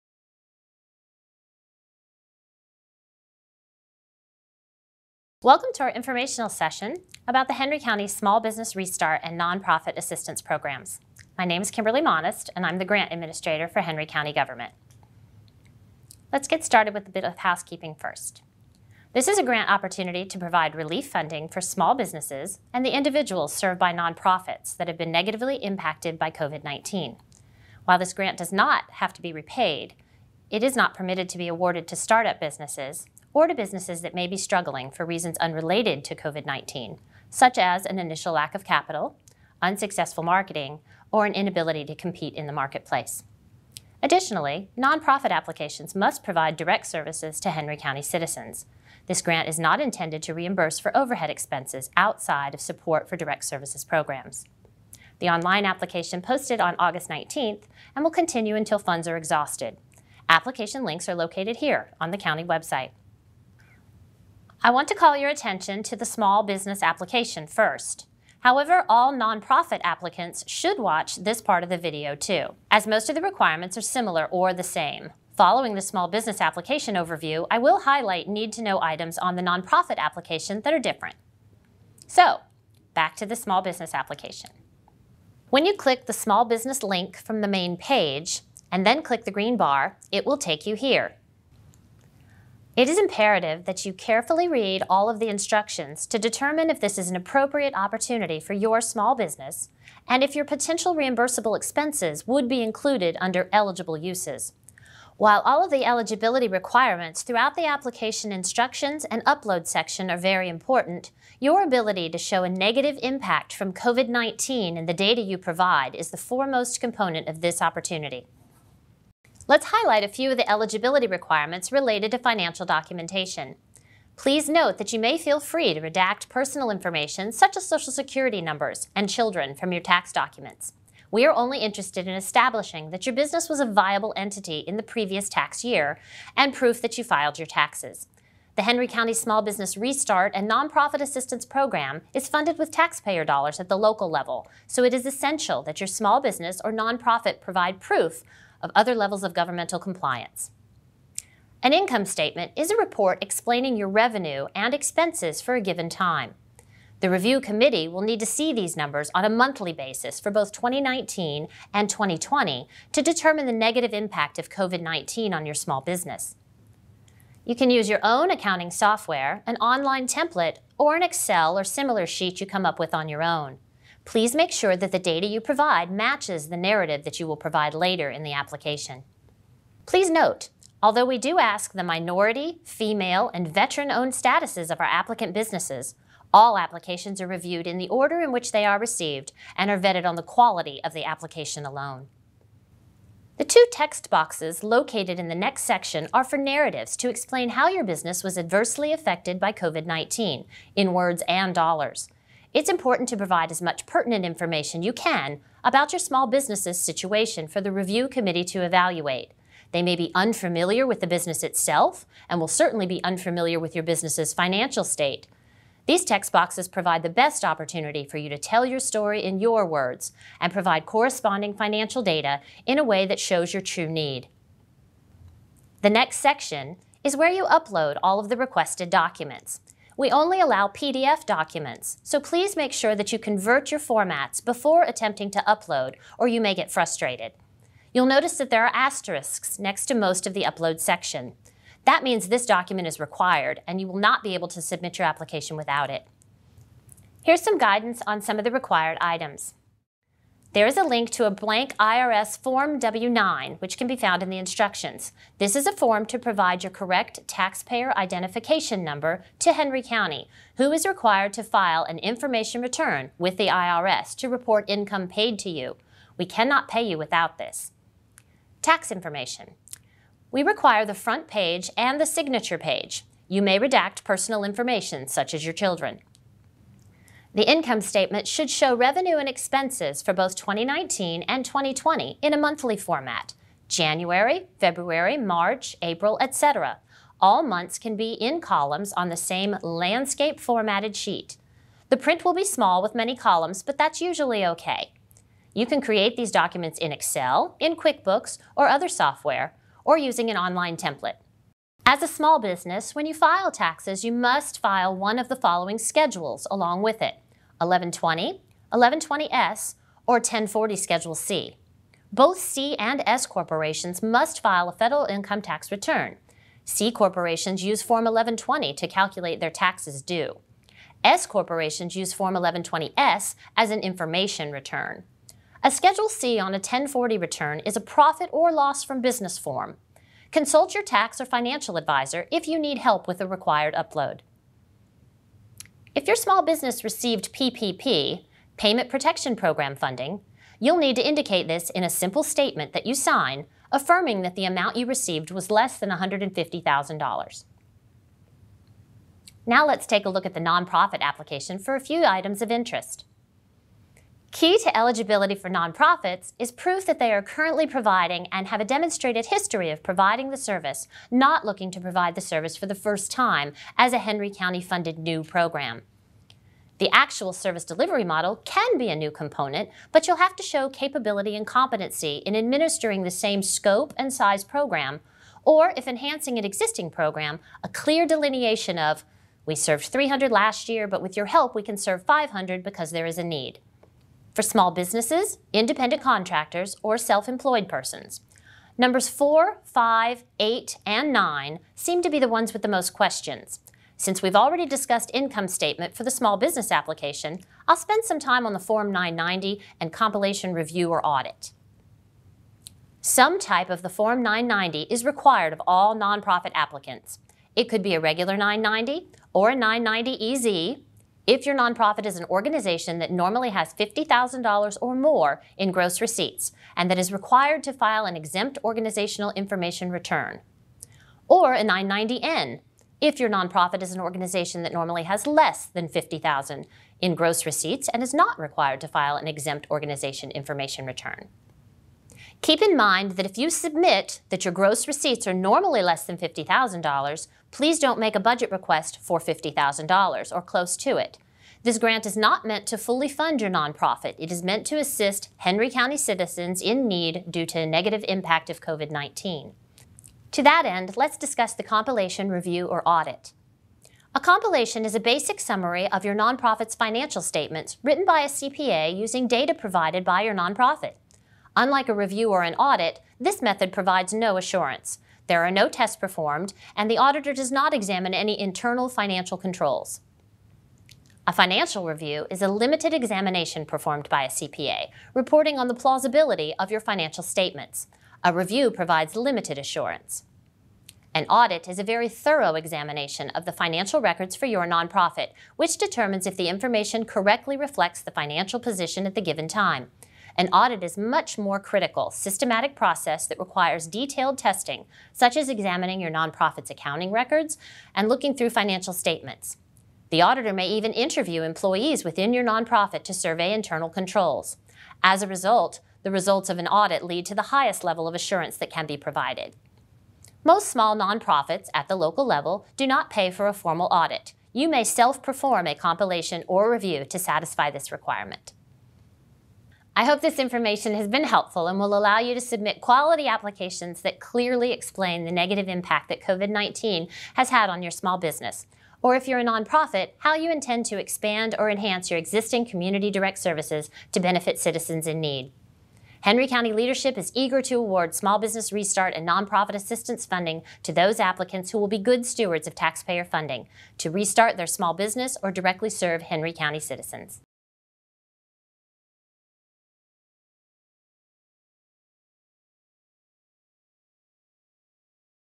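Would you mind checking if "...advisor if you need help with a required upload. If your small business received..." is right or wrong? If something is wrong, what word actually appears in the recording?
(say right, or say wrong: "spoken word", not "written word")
right.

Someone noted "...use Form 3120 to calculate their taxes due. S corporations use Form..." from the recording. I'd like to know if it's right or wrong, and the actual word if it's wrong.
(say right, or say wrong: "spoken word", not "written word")
wrong: "1120", not "3120".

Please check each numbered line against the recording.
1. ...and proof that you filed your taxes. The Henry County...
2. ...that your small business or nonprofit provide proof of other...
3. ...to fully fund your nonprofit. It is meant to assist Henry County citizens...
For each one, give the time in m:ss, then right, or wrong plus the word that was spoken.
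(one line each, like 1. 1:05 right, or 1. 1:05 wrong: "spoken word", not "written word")
1. 2:16 right
2. 2:25 right
3. 7:22 right.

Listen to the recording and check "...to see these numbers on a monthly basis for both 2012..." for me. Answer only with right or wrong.
wrong.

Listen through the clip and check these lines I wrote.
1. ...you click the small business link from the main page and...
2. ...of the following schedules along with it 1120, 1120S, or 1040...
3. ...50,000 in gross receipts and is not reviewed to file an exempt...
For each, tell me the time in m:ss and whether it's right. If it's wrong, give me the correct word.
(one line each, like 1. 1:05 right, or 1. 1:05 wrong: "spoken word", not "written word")
1. 1:25 right
2. 5:05 right
3. 7:05 wrong: "required", not "reviewed".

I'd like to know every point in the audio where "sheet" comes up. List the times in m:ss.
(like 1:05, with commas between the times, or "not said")
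2:52, 4:50.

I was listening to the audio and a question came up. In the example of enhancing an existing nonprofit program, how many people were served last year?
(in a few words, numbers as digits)
300.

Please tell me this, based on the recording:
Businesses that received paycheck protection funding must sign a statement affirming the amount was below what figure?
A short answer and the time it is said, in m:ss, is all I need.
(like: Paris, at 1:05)
$150,000, at 5:45.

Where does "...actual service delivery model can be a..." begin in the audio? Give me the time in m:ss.
6:06.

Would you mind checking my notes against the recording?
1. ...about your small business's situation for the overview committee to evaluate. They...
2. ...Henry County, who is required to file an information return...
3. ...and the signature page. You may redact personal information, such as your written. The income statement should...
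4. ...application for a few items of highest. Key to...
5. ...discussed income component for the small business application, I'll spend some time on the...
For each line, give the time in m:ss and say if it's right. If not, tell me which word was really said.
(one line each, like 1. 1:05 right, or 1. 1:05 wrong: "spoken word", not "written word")
1. 3:25 wrong: "review", not "overview"
2. 4:19 right
3. 4:31 wrong: "children", not "written"
4. 5:51 wrong: "interest", not "highest"
5. 6:34 wrong: "statement", not "component".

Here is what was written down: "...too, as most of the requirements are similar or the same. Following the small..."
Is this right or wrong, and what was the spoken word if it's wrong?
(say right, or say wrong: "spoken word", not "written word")
right.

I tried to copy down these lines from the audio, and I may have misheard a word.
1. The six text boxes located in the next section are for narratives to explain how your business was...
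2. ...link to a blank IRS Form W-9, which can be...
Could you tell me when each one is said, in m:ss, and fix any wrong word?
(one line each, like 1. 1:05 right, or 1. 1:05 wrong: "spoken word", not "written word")
1. 3:13 wrong: "two", not "six"
2. 4:10 right.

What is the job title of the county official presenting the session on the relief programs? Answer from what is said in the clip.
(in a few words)
Grant Administrator.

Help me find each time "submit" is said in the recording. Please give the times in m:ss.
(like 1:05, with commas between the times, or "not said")
4:04, 7:13, 8:42.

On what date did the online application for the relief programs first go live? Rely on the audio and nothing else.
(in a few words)
August 19th.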